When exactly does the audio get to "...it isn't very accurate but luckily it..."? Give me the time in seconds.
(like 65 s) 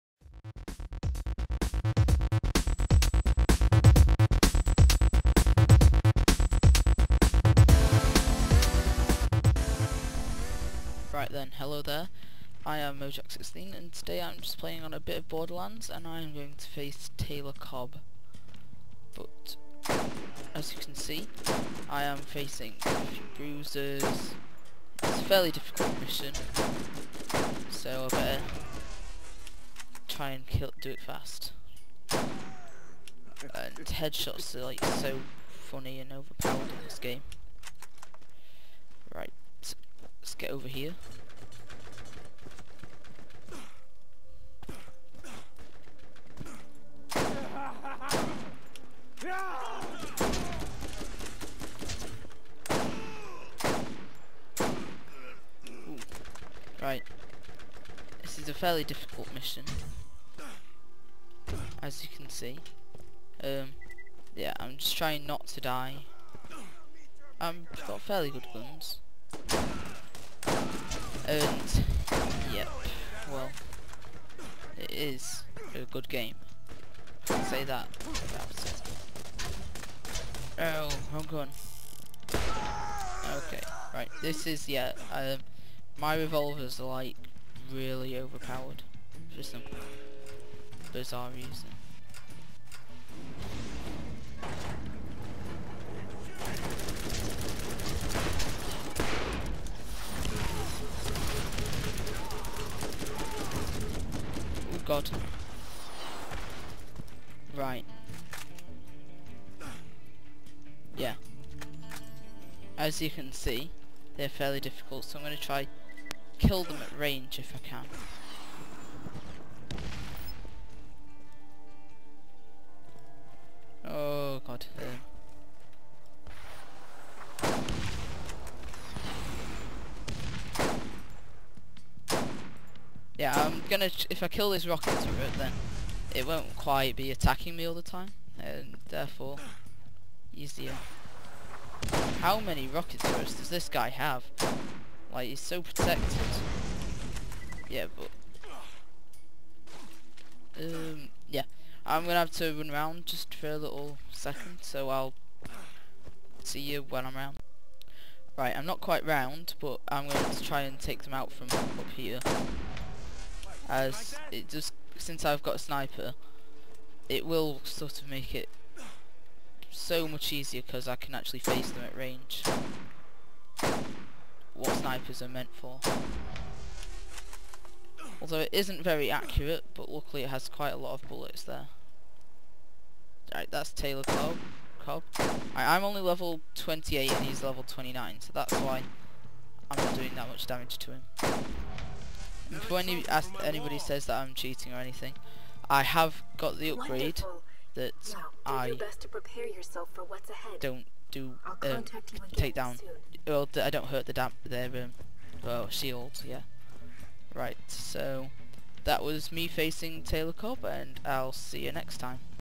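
178 s.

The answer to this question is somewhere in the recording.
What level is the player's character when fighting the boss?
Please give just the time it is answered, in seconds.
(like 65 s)
186 s.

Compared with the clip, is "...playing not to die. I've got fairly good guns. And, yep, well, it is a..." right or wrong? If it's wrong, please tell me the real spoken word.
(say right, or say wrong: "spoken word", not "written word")
wrong: "trying", not "playing".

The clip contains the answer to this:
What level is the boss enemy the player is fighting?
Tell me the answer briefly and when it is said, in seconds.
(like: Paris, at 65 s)
29, at 187 s.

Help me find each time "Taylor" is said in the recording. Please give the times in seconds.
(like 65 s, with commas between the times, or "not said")
17 s, 183 s, 210 s.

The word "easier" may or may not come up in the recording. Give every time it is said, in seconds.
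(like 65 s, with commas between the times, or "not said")
140 s, 170 s.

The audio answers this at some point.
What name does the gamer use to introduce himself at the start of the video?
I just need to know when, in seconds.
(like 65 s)
12 s.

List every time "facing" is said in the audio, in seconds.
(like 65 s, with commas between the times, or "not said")
22 s, 209 s.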